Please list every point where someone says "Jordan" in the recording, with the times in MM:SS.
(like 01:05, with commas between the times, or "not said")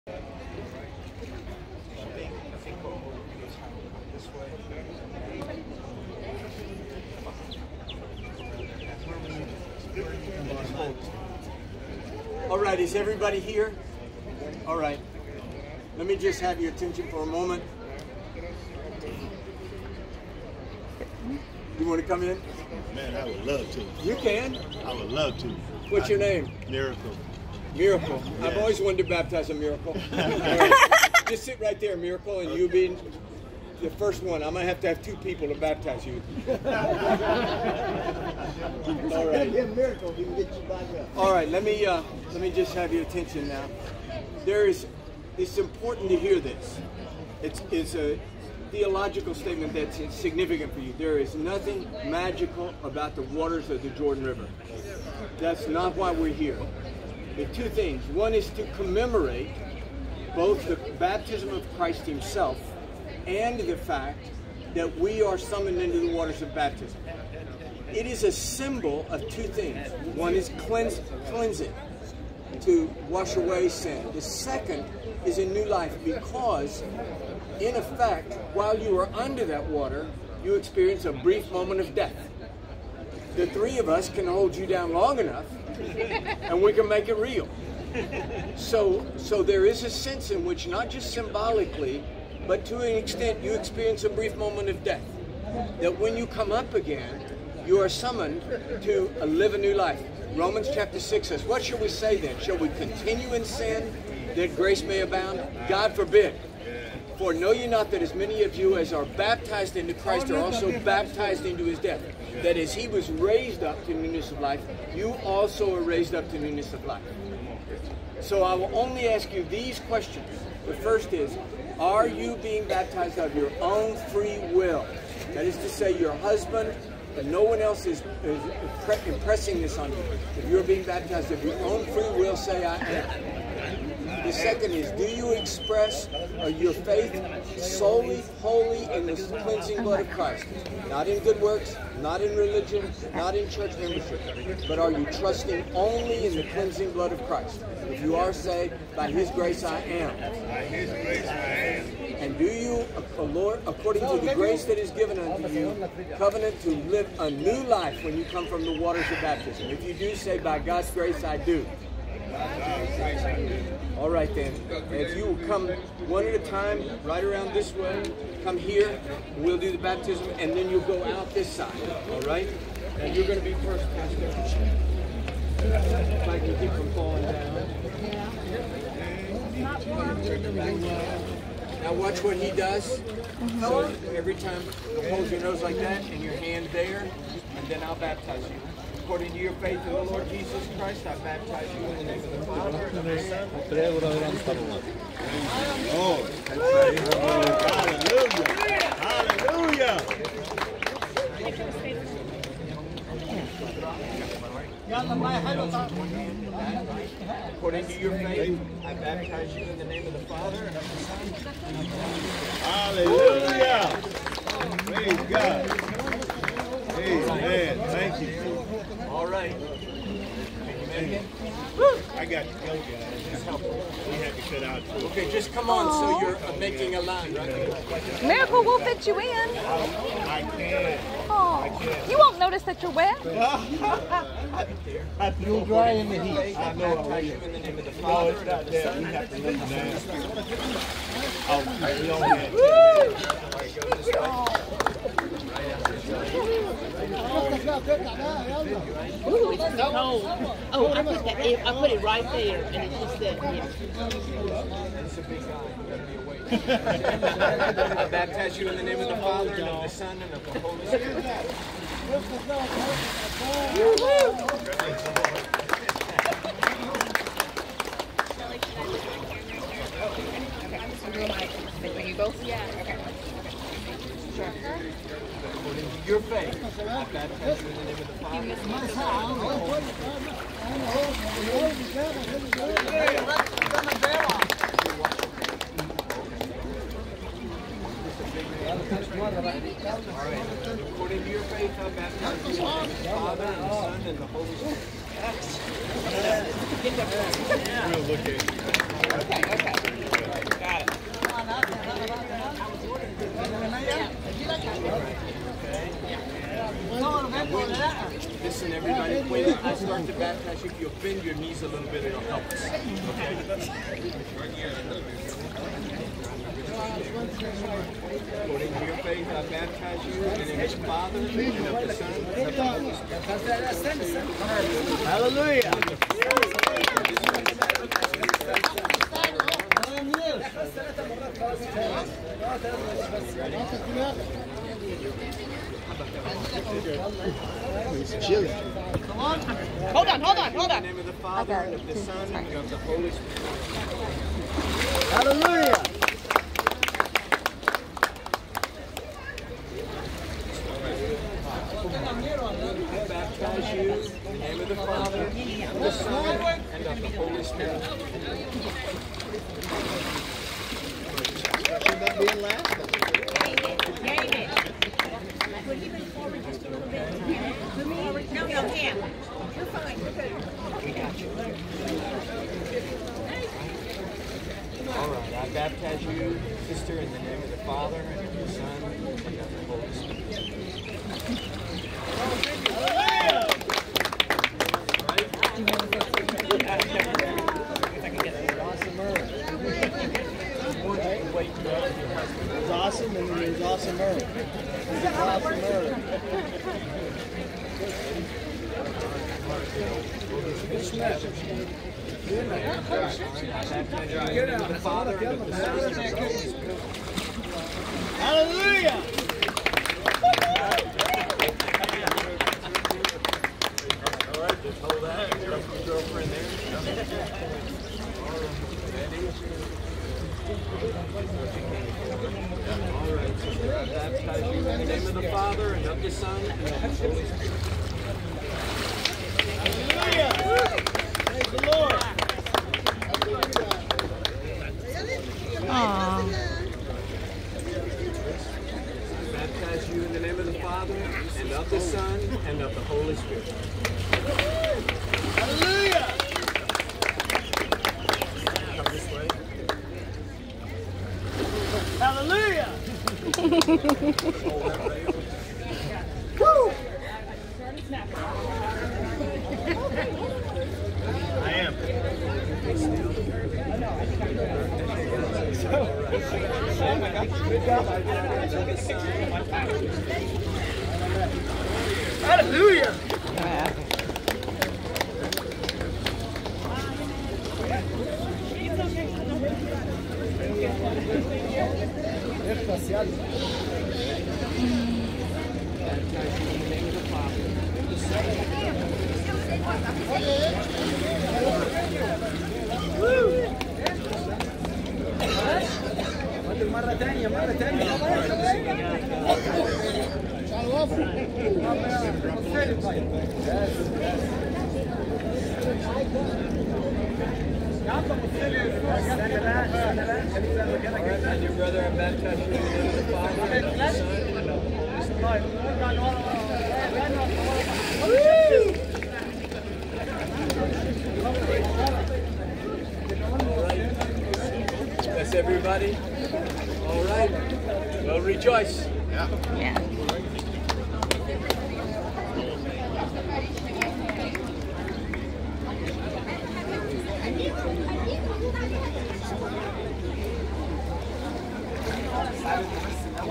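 00:53.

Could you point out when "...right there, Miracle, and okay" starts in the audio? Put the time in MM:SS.
00:31.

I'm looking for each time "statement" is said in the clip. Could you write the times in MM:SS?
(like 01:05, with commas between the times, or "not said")
00:49.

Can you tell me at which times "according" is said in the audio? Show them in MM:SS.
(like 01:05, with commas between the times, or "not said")
02:33, 03:09, 03:27, 04:33, 04:50, 05:17.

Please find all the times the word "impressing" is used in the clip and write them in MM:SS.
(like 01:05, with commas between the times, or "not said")
02:09.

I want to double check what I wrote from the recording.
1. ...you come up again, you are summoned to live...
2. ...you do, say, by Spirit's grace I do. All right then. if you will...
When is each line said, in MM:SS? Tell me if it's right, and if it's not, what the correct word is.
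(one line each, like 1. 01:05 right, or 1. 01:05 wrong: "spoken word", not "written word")
1. 01:36 right
2. 02:39 wrong: "God", not "Spirit".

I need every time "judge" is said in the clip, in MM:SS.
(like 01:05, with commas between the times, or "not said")
not said.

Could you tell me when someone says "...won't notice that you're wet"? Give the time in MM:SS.
03:52.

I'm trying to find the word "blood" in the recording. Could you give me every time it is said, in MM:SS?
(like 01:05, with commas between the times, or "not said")
02:19, 02:26.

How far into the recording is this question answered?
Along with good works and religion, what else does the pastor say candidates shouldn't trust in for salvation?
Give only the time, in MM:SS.
02:23.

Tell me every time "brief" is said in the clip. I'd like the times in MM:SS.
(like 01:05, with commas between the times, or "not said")
01:21, 01:34.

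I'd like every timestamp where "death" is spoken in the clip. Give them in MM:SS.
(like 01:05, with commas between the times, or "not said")
01:21, 01:34, 01:51.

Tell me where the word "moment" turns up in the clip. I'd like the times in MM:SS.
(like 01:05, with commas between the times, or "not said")
00:17, 01:21, 01:34.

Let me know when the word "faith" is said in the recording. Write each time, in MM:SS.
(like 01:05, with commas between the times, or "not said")
02:16, 03:09, 03:28, 04:36, 04:51, 05:18.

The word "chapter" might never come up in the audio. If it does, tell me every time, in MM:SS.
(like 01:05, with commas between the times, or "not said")
01:40.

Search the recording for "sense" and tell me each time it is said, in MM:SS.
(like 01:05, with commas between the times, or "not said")
01:29.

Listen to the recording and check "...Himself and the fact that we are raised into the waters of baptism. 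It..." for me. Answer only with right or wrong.
wrong.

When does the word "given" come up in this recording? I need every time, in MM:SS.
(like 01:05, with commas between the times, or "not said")
02:34.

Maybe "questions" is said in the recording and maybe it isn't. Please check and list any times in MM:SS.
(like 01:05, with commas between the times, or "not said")
01:59.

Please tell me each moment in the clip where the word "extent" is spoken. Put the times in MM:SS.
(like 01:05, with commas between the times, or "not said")
01:32.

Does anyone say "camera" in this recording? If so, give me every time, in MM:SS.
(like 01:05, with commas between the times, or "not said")
04:28.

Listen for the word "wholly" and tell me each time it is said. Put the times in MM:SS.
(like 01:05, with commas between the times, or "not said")
02:18.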